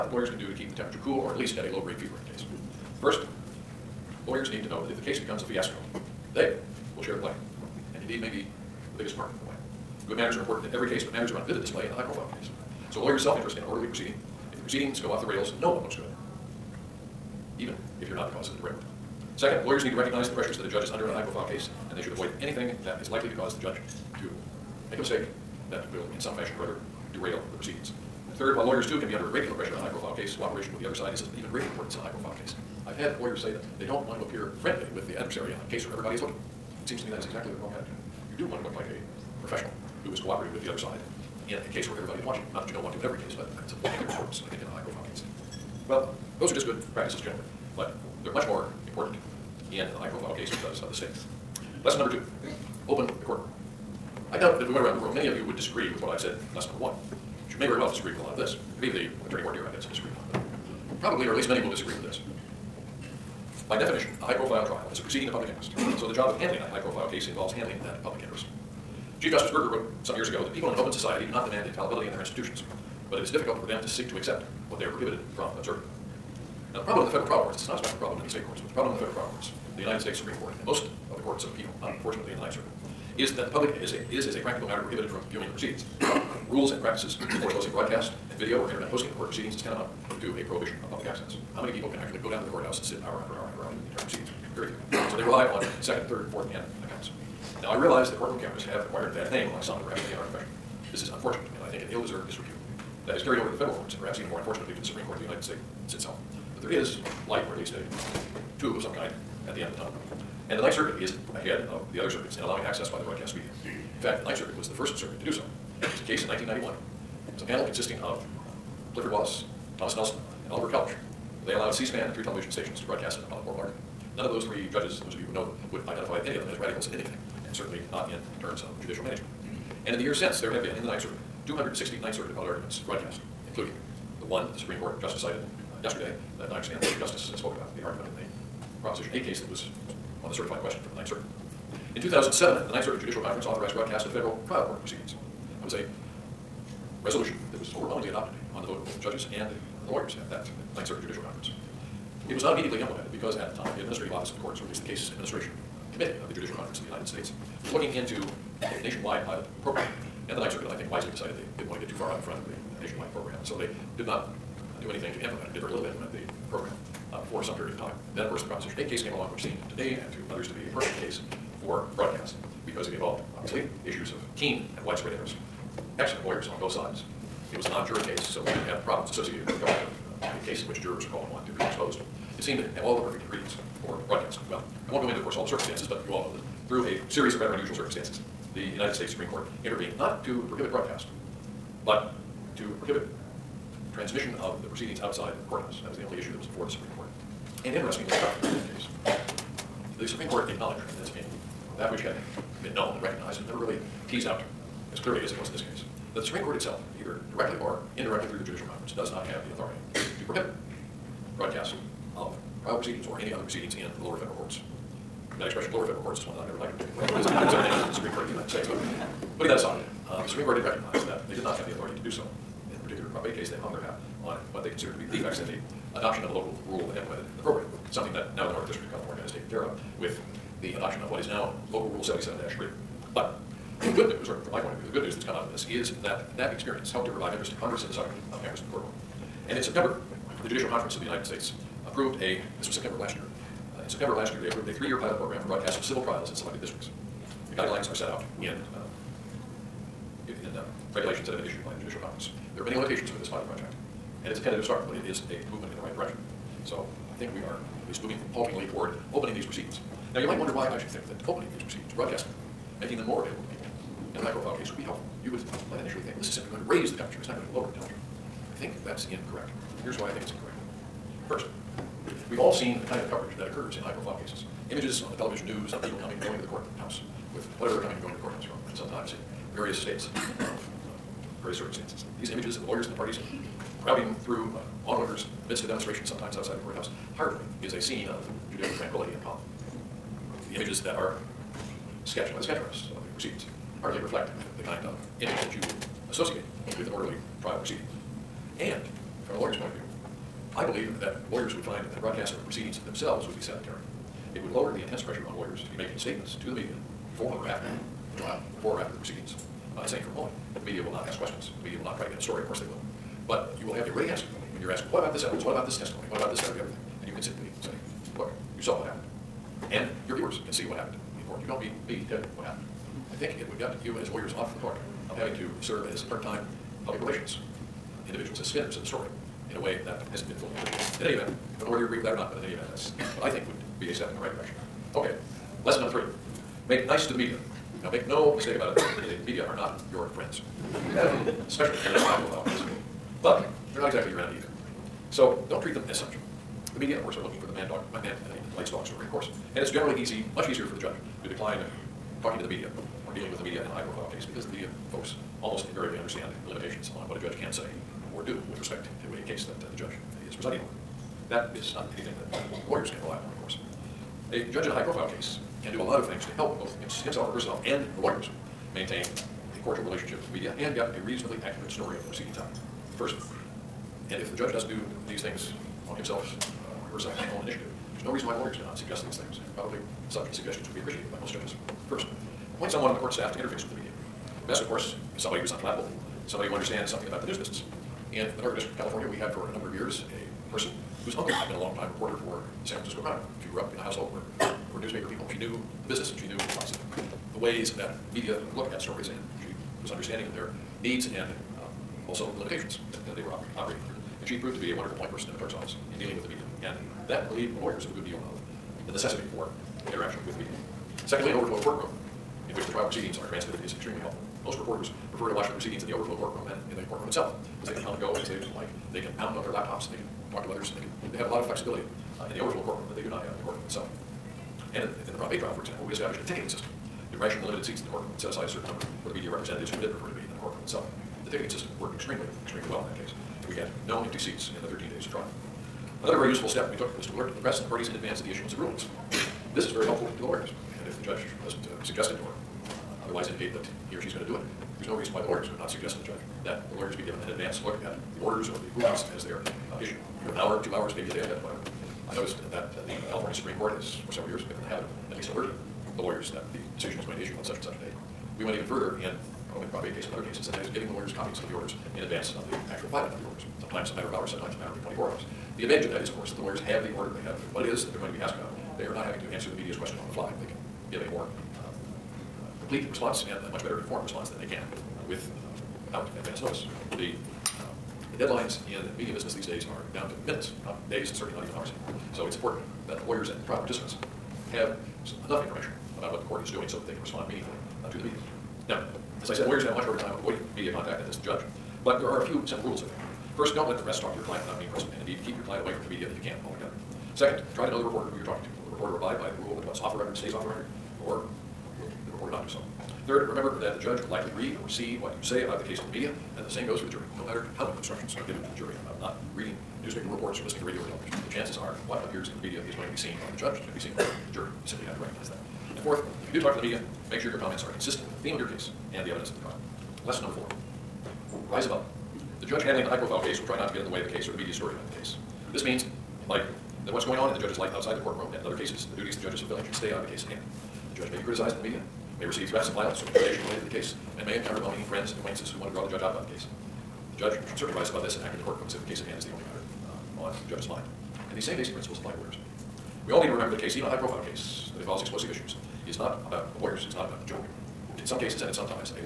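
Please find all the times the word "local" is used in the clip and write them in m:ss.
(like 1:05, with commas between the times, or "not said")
3:46, 3:51.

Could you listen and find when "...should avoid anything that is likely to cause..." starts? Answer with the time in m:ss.
0:22.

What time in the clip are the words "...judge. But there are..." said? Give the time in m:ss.
8:11.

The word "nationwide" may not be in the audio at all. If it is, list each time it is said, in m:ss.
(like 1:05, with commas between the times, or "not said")
2:38, 2:42.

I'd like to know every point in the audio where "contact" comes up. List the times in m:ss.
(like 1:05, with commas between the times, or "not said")
8:10.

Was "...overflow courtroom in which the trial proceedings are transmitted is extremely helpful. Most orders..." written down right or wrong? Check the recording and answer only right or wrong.
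wrong.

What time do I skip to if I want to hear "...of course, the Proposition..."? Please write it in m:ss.
2:48.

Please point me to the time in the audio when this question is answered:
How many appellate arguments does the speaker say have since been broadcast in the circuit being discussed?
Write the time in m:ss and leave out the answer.
2:11.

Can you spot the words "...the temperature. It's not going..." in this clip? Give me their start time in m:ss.
4:26.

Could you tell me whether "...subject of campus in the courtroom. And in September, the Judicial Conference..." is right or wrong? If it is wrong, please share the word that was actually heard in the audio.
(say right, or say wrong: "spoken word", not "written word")
right.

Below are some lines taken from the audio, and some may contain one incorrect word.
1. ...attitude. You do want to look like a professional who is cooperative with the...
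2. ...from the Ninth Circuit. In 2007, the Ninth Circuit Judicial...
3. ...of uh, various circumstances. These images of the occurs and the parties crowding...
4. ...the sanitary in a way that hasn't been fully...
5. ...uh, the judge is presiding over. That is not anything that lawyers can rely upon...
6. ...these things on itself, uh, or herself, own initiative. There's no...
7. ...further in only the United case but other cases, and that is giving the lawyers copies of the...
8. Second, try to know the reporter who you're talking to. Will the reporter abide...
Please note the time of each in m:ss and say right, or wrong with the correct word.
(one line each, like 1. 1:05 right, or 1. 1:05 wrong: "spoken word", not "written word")
1. 0:37 right
2. 2:20 right
3. 4:40 wrong: "lawyers", not "occurs"
4. 5:28 wrong: "story", not "sanitary"
5. 5:59 right
6. 6:15 wrong: "himself", not "itself"
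7. 7:38 wrong: "Prop", not "United"
8. 8:17 right.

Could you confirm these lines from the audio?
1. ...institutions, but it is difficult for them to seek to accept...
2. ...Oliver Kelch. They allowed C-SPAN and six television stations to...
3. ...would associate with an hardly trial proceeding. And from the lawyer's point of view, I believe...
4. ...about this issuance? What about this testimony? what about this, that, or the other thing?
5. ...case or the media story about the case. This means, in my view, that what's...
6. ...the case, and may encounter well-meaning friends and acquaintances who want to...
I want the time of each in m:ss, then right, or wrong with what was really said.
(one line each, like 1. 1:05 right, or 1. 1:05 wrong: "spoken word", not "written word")
1. 1:12 right
2. 2:00 wrong: "three", not "six"
3. 4:55 wrong: "orderly", not "hardly"
4. 5:14 wrong: "evidence", not "issuance"
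5. 8:44 right
6. 8:53 right.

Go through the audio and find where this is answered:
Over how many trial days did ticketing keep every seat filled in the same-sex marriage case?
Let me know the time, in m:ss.
7:14.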